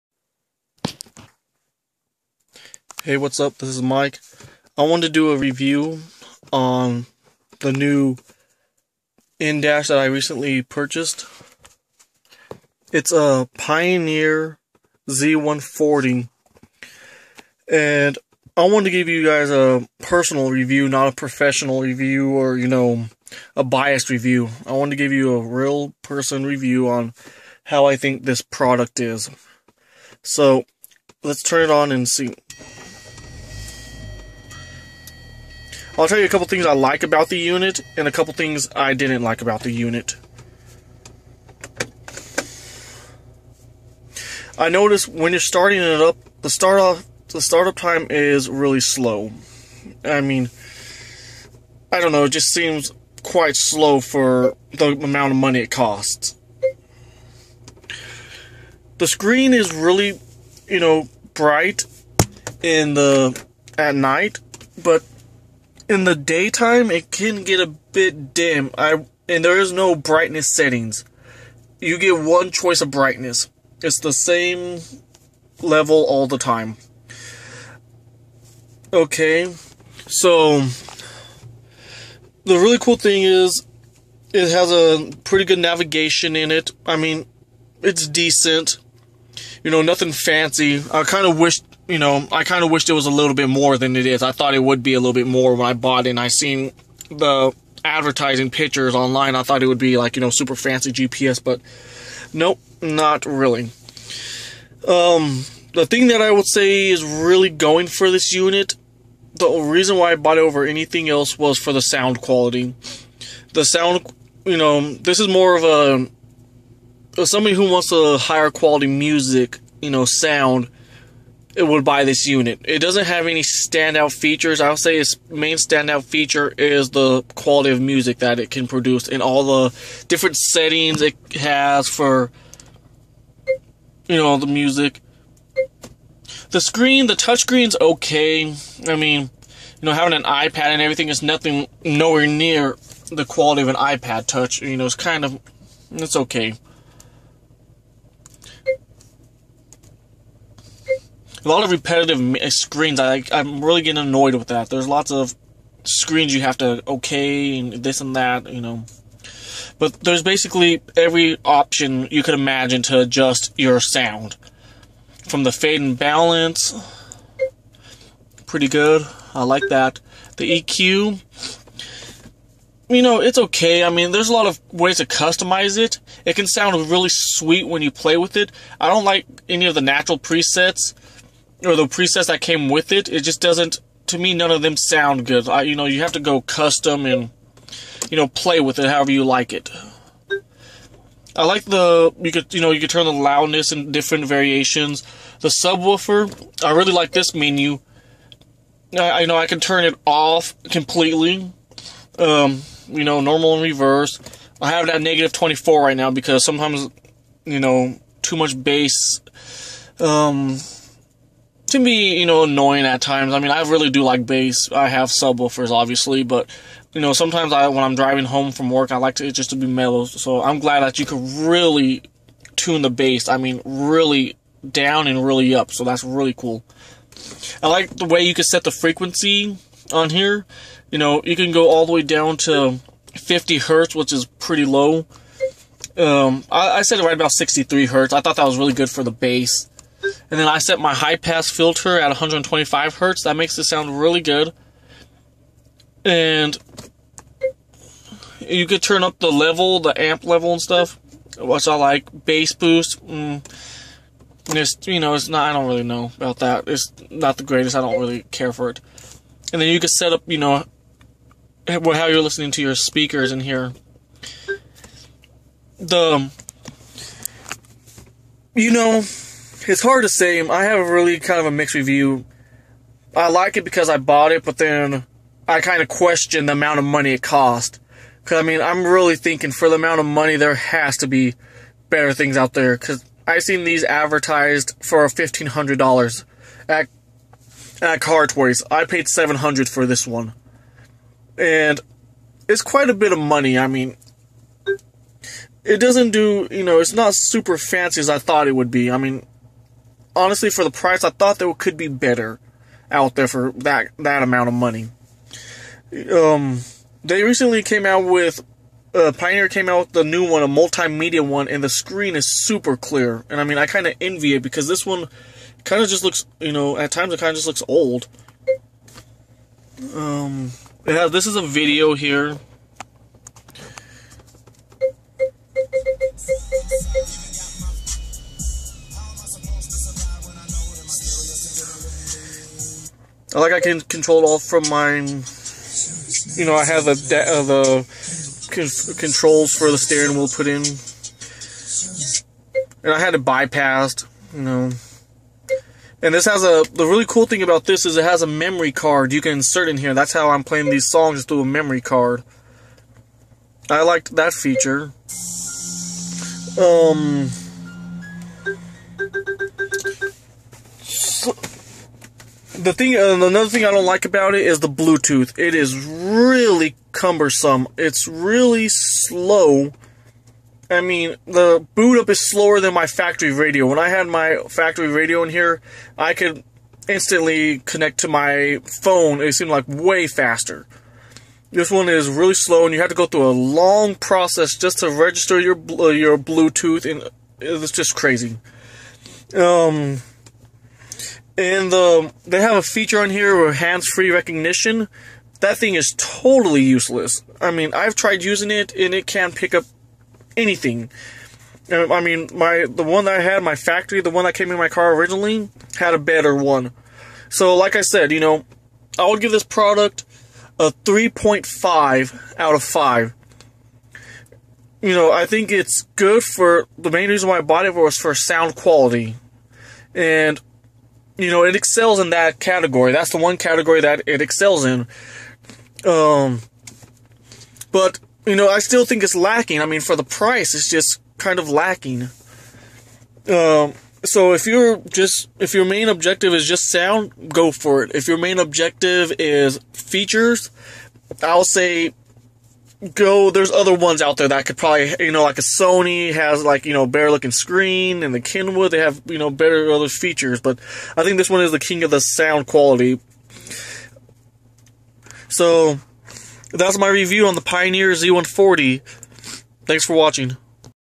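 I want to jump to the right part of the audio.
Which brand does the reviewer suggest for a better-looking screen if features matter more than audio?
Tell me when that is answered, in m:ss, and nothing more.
7:25.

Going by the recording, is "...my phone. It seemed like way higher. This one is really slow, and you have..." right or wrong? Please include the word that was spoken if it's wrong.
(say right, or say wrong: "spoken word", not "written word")
wrong: "faster", not "higher".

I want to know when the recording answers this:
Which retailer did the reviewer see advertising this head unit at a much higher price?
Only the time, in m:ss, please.
4:48.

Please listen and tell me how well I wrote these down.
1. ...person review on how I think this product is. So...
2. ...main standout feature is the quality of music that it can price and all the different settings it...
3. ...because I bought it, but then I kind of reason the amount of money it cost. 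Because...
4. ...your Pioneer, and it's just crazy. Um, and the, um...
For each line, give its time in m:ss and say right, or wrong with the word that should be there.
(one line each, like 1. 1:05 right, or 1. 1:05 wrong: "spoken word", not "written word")
1. 0:26 right
2. 2:05 wrong: "produce", not "price"
3. 4:33 wrong: "question", not "reason"
4. 6:25 wrong: "Bluetooth", not "Pioneer".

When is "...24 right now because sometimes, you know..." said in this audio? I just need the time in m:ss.
3:25.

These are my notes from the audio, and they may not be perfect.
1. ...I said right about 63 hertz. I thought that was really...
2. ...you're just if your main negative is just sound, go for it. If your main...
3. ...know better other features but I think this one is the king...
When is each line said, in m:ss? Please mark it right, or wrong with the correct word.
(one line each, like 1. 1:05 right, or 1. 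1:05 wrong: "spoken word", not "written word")
1. 3:56 right
2. 7:14 wrong: "objective", not "negative"
3. 7:29 right.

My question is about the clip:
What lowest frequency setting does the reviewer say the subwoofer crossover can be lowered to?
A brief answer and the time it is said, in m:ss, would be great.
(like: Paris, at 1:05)
50 hertz, at 3:53.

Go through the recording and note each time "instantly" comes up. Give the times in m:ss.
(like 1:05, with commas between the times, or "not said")
6:16.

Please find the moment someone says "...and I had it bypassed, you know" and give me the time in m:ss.
5:42.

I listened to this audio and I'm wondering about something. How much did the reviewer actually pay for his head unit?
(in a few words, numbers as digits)
$700.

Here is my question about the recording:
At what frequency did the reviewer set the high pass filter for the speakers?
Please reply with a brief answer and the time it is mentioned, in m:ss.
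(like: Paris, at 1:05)
125 hertz, at 4:02.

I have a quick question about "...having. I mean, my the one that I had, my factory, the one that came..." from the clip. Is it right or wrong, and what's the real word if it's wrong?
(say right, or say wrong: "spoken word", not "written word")
wrong: "anything", not "having".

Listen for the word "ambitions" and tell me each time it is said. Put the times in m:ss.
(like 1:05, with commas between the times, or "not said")
not said.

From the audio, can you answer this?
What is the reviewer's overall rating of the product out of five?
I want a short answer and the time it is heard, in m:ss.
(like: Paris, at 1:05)
3.5, at 6:50.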